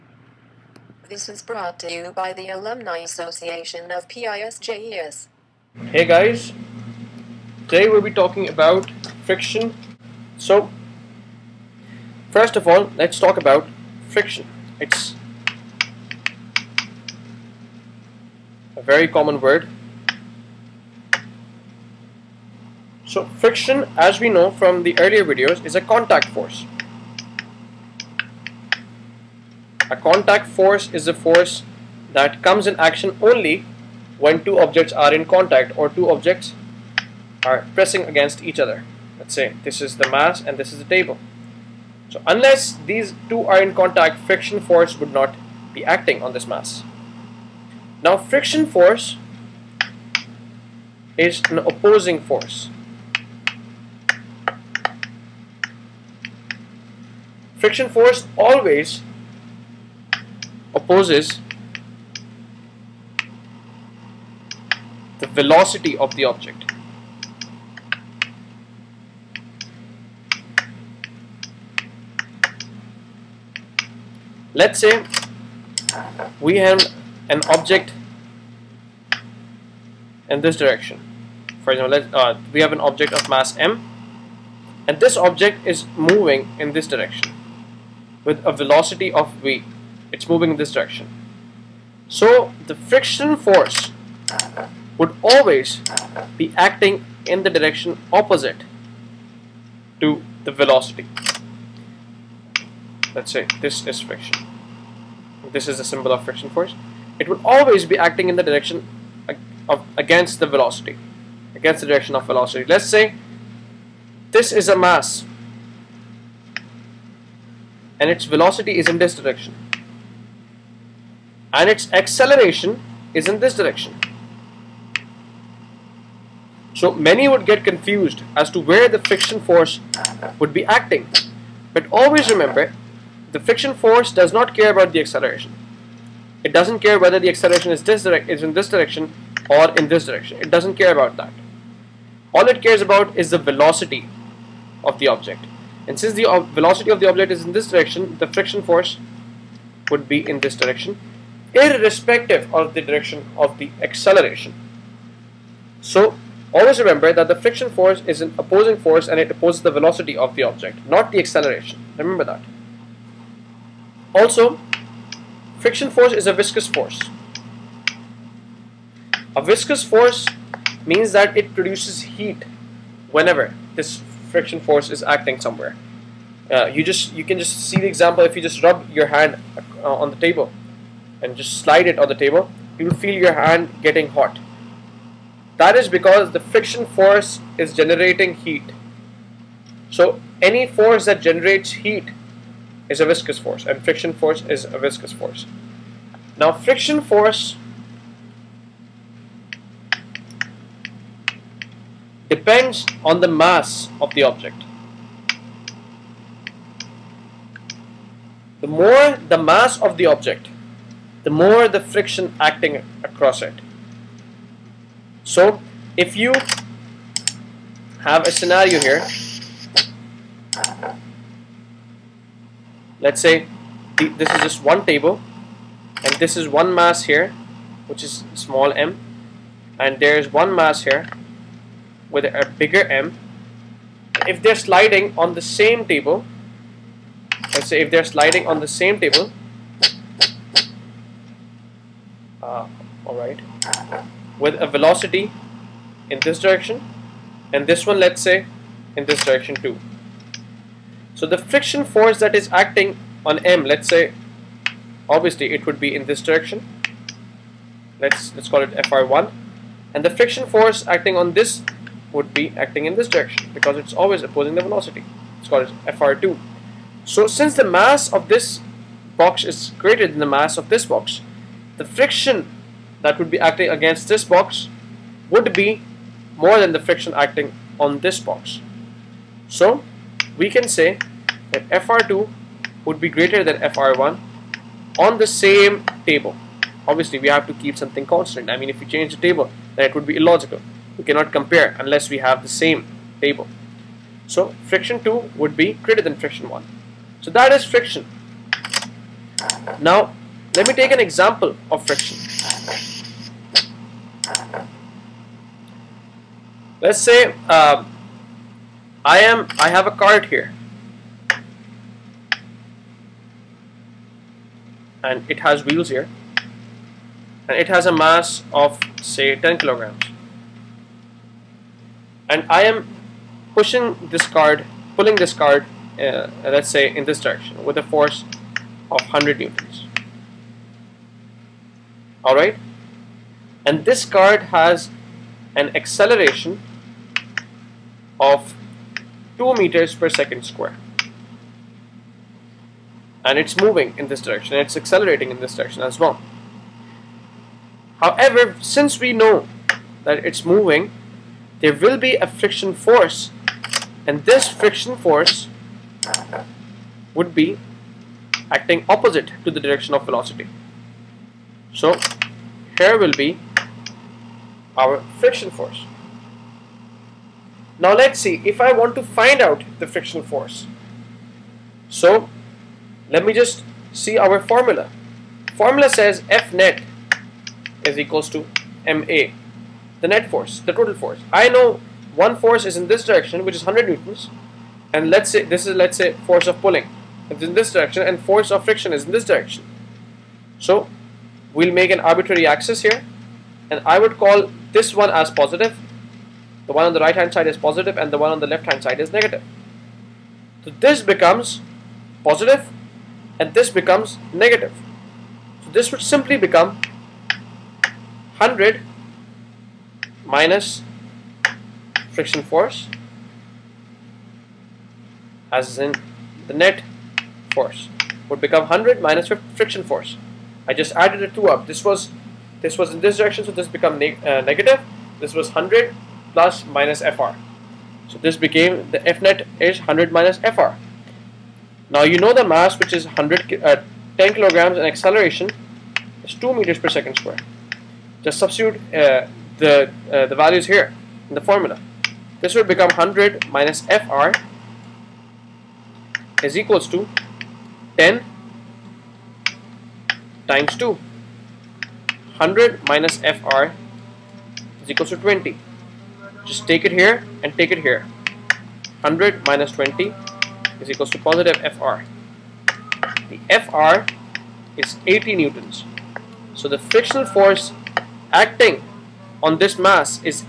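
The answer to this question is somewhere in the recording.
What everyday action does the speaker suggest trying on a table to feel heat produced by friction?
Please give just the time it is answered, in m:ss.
2:58.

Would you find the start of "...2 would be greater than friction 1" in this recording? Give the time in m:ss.
4:55.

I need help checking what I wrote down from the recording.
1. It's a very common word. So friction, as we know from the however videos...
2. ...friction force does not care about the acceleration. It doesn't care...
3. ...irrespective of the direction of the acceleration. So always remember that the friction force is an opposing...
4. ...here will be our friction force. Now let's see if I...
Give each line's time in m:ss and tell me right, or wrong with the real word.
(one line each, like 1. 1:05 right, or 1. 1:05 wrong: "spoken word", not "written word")
1. 0:14 wrong: "earlier", not "however"
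2. 2:13 right
3. 2:31 right
4. 6:02 right.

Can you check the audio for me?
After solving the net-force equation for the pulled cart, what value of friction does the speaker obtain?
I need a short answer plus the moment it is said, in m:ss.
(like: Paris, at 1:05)
80 newtons, at 7:45.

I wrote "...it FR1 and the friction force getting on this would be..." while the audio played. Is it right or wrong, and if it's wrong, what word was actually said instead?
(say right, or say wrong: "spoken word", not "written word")
wrong: "acting", not "getting".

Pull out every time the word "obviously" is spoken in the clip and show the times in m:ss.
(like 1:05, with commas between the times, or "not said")
4:15, 4:46.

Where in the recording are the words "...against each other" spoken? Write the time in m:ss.
0:38.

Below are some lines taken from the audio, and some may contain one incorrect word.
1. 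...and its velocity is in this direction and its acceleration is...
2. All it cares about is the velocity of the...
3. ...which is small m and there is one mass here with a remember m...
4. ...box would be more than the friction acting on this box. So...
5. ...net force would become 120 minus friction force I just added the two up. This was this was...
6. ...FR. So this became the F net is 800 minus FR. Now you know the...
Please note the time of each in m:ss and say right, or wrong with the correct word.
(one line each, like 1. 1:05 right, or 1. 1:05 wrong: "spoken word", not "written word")
1. 1:57 right
2. 2:22 right
3. 3:47 wrong: "bigger", not "remember"
4. 4:34 right
5. 6:56 wrong: "100", not "120"
6. 7:07 wrong: "100", not "800".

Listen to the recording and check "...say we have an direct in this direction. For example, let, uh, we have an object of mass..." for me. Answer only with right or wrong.
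wrong.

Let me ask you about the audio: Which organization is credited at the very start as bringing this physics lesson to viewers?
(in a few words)
Alumni Association of PISJES.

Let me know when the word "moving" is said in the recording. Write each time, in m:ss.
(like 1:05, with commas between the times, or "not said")
1:25, 1:30, 5:43, 5:50.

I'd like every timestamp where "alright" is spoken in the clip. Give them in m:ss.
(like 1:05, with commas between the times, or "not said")
4:03, 5:32.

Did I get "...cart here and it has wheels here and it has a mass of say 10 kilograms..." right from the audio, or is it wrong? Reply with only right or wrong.
right.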